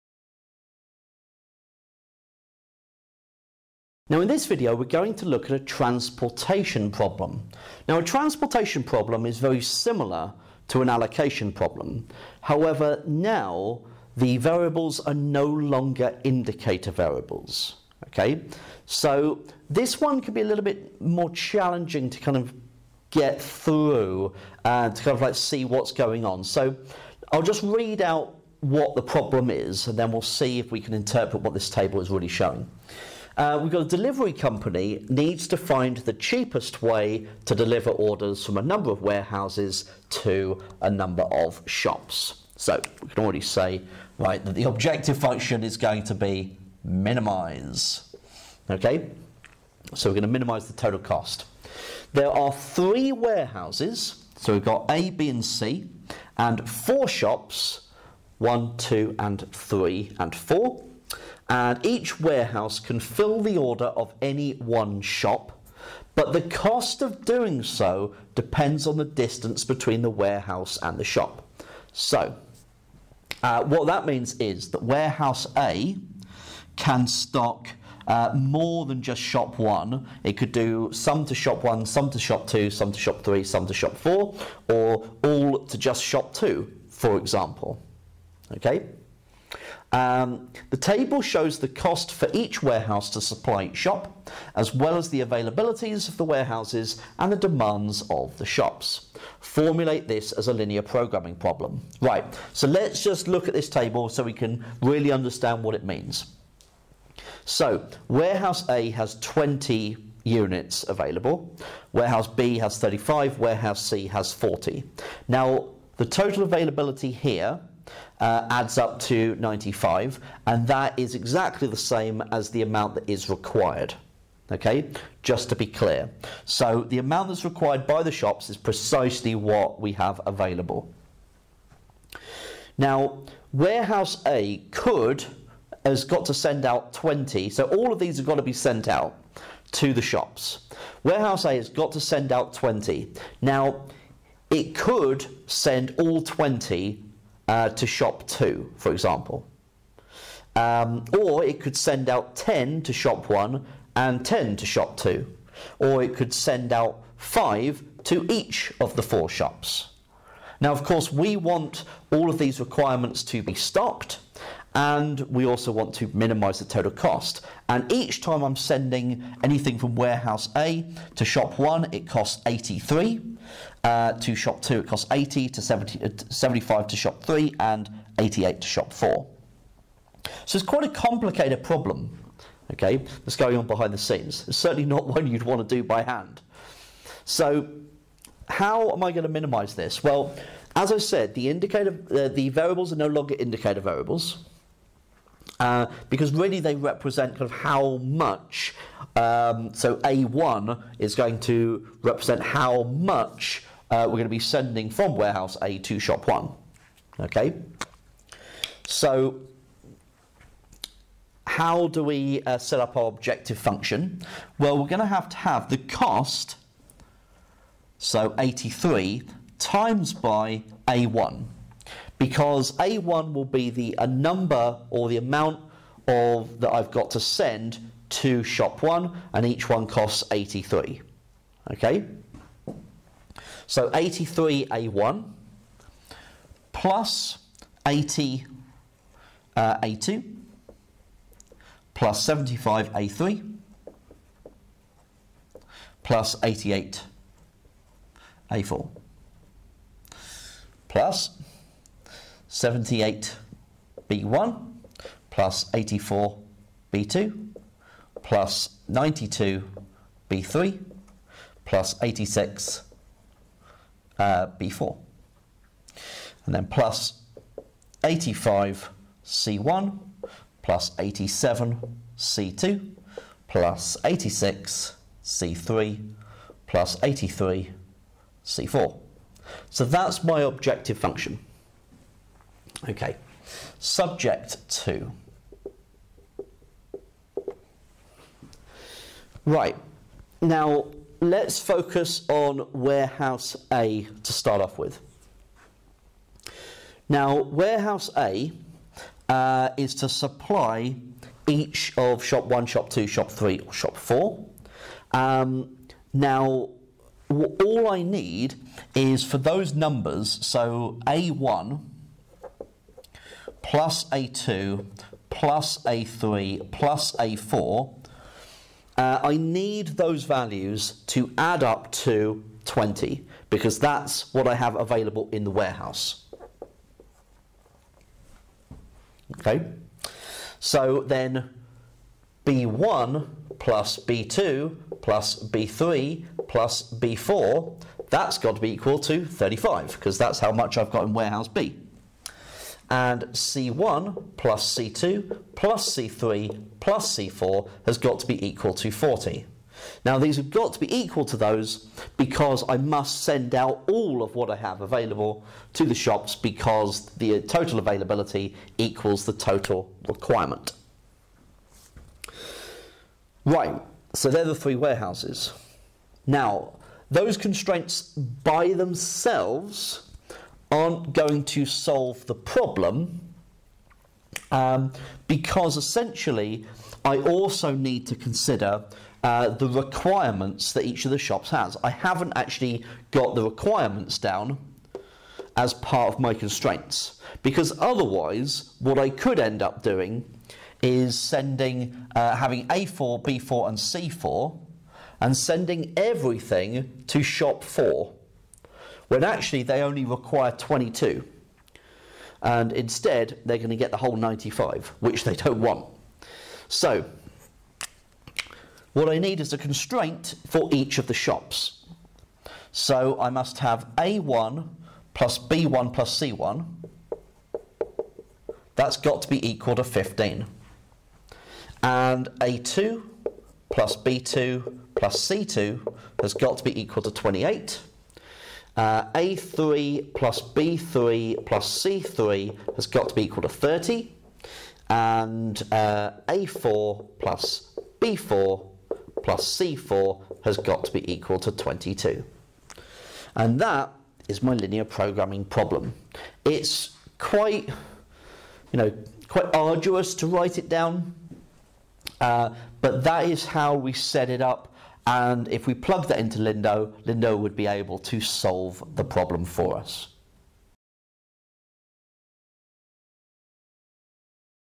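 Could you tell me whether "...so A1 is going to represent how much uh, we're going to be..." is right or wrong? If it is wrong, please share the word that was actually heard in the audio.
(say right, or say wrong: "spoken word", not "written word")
right.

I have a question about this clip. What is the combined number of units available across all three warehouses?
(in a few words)
95.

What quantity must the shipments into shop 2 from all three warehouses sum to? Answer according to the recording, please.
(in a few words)
28.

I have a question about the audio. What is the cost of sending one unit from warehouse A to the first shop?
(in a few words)
83.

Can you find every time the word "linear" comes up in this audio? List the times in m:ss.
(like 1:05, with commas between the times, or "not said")
1:40, 7:24.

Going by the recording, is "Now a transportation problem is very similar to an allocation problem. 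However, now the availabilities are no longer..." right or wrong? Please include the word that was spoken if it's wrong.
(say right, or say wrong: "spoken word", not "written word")
wrong: "variables", not "availabilities".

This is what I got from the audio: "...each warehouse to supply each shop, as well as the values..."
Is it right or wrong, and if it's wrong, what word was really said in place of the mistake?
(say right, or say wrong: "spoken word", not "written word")
wrong: "availabilities", not "values".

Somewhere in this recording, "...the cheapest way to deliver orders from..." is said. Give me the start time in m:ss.
0:35.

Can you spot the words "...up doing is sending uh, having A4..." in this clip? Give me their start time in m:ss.
6:29.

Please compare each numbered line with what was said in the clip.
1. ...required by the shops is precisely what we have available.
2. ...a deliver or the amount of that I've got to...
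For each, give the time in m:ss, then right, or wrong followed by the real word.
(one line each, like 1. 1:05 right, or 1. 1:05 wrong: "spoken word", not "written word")
1. 2:07 right
2. 3:43 wrong: "number", not "deliver".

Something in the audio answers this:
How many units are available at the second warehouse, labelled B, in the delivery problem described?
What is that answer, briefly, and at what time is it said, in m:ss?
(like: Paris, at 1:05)
35, at 1:51.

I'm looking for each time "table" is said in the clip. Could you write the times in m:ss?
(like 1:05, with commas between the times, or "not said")
0:31, 1:30, 1:43.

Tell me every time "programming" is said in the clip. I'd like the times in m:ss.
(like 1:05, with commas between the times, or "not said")
1:40, 7:24.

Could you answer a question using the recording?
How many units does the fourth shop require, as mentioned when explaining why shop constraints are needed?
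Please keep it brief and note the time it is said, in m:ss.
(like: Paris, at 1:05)
22, at 6:39.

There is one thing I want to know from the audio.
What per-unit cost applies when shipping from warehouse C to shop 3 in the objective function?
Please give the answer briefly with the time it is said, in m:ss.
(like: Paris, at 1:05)
86, at 4:34.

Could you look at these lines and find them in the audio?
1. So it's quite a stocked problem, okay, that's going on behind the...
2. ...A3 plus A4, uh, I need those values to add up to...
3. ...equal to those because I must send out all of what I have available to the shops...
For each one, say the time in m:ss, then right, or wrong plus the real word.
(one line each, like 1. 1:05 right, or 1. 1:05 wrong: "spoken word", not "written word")
1. 3:00 wrong: "complicated", not "stocked"
2. 5:15 right
3. 5:50 right.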